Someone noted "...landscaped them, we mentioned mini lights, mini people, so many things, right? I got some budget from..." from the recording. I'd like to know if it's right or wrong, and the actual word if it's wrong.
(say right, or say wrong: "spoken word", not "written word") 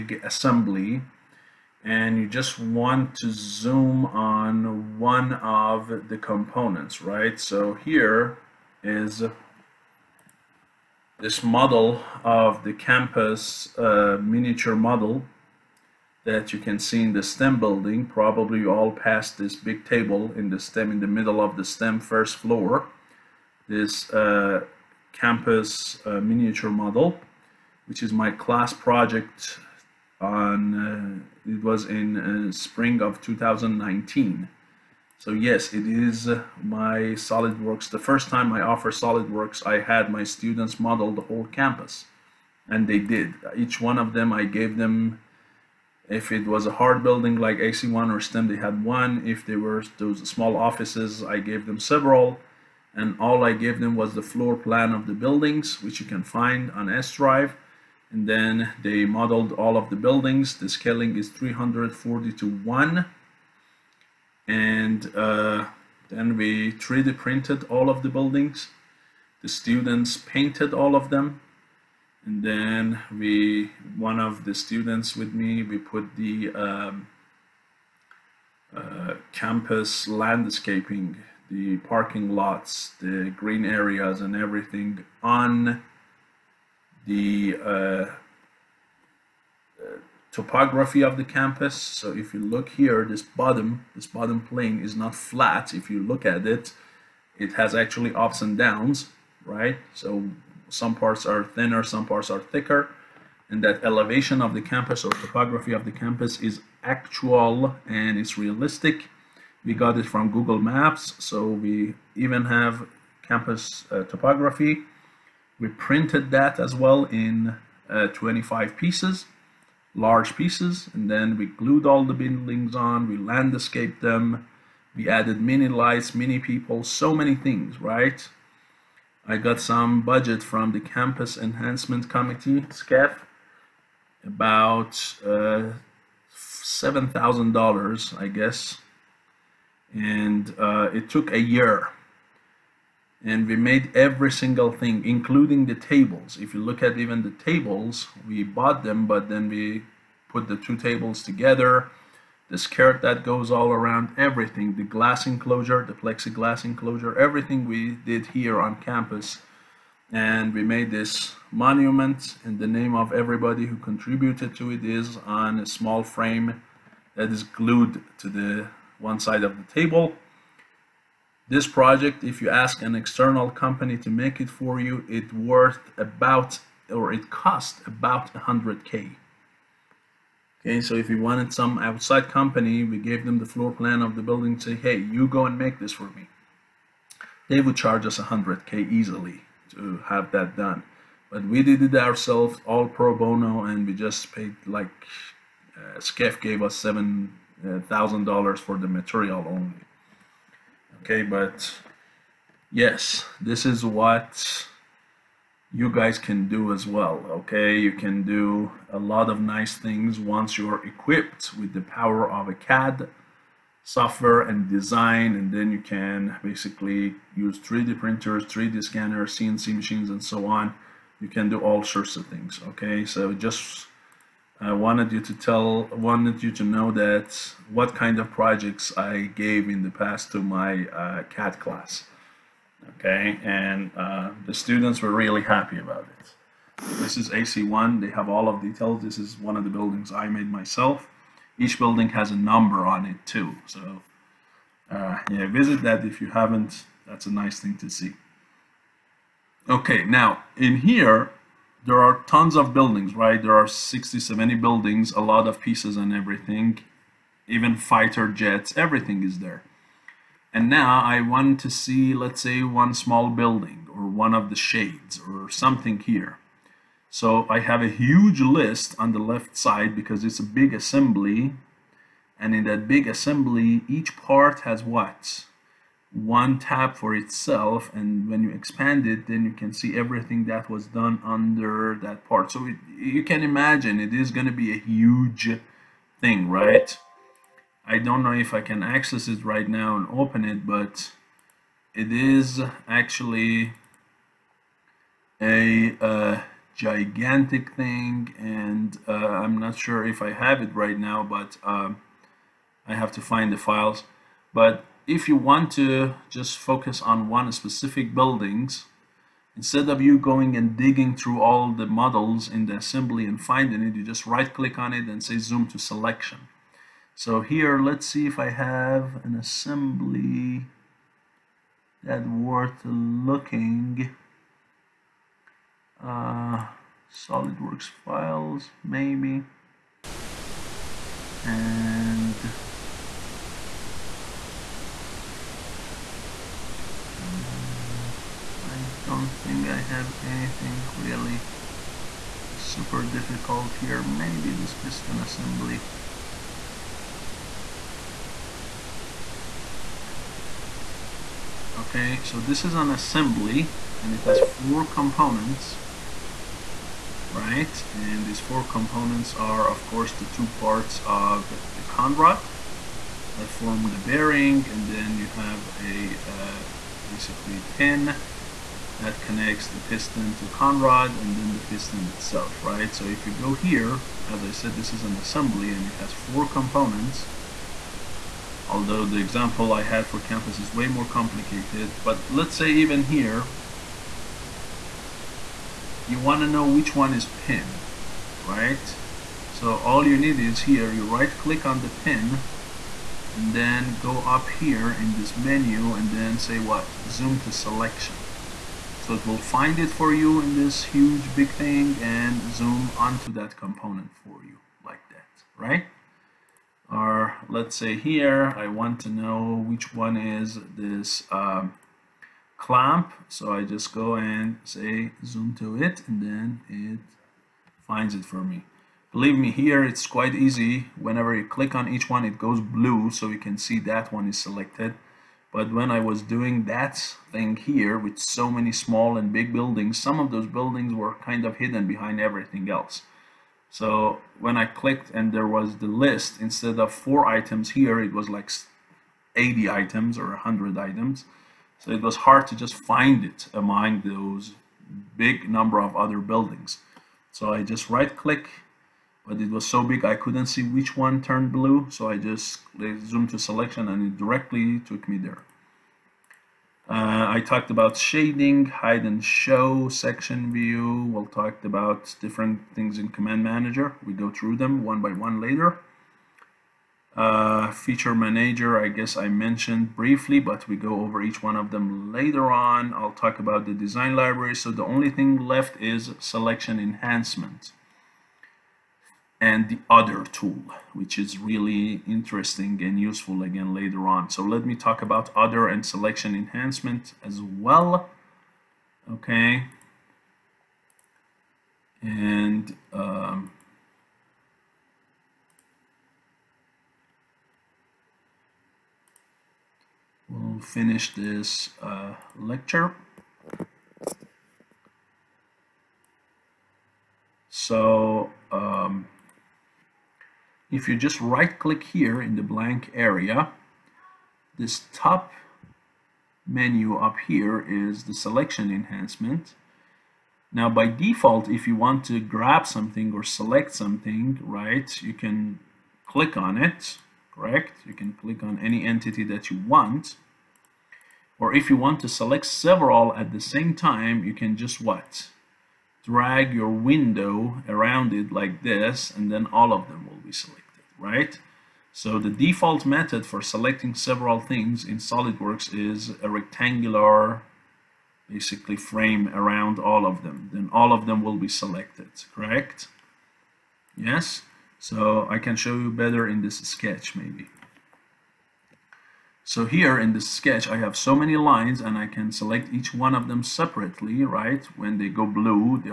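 wrong: "added", not "mentioned".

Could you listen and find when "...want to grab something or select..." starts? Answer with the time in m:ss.
8:41.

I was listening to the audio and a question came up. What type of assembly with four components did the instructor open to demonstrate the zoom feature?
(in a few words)
Piston assembly.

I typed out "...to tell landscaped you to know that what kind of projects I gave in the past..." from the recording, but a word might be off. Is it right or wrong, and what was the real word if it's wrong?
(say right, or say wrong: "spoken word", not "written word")
wrong: "wanted", not "landscaped".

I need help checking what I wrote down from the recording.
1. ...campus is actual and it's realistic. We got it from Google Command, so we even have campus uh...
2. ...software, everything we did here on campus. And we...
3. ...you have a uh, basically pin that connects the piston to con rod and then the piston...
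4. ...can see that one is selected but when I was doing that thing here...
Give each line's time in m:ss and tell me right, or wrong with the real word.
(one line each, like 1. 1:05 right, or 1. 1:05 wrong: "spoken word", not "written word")
1. 1:45 wrong: "Maps", not "Command"
2. 2:36 wrong: "enclosure", not "software"
3. 6:05 right
4. 7:03 right.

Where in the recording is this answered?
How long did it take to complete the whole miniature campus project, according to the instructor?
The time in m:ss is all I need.
2:21.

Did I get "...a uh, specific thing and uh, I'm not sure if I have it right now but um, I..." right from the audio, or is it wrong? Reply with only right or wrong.
wrong.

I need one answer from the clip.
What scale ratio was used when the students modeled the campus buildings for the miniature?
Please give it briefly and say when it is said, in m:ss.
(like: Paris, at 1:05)
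340 to 1, at 1:01.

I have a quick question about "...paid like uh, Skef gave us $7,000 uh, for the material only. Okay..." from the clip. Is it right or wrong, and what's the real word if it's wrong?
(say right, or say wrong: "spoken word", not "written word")
right.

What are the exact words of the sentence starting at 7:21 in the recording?
So it was hard to just find it among those big number of other buildings.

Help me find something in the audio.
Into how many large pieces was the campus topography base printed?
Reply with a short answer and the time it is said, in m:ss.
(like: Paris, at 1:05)
25, at 1:58.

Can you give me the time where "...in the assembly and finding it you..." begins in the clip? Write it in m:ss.
5:12.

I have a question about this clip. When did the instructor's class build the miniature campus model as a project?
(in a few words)
Spring 2019.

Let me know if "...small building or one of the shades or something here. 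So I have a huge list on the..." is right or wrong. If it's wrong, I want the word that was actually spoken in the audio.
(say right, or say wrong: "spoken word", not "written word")
right.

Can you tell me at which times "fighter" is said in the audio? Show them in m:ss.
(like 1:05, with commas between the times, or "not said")
4:17.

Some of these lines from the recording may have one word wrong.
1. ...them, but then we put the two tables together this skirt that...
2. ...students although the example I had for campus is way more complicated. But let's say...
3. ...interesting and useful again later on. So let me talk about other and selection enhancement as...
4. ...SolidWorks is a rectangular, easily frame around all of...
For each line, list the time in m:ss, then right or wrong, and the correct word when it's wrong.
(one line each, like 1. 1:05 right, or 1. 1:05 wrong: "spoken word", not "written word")
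1. 2:28 right
2. 6:16 wrong: "components", not "students"
3. 8:02 right
4. 9:04 wrong: "basically", not "easily".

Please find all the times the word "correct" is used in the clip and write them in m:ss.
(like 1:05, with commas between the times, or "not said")
8:47, 9:12.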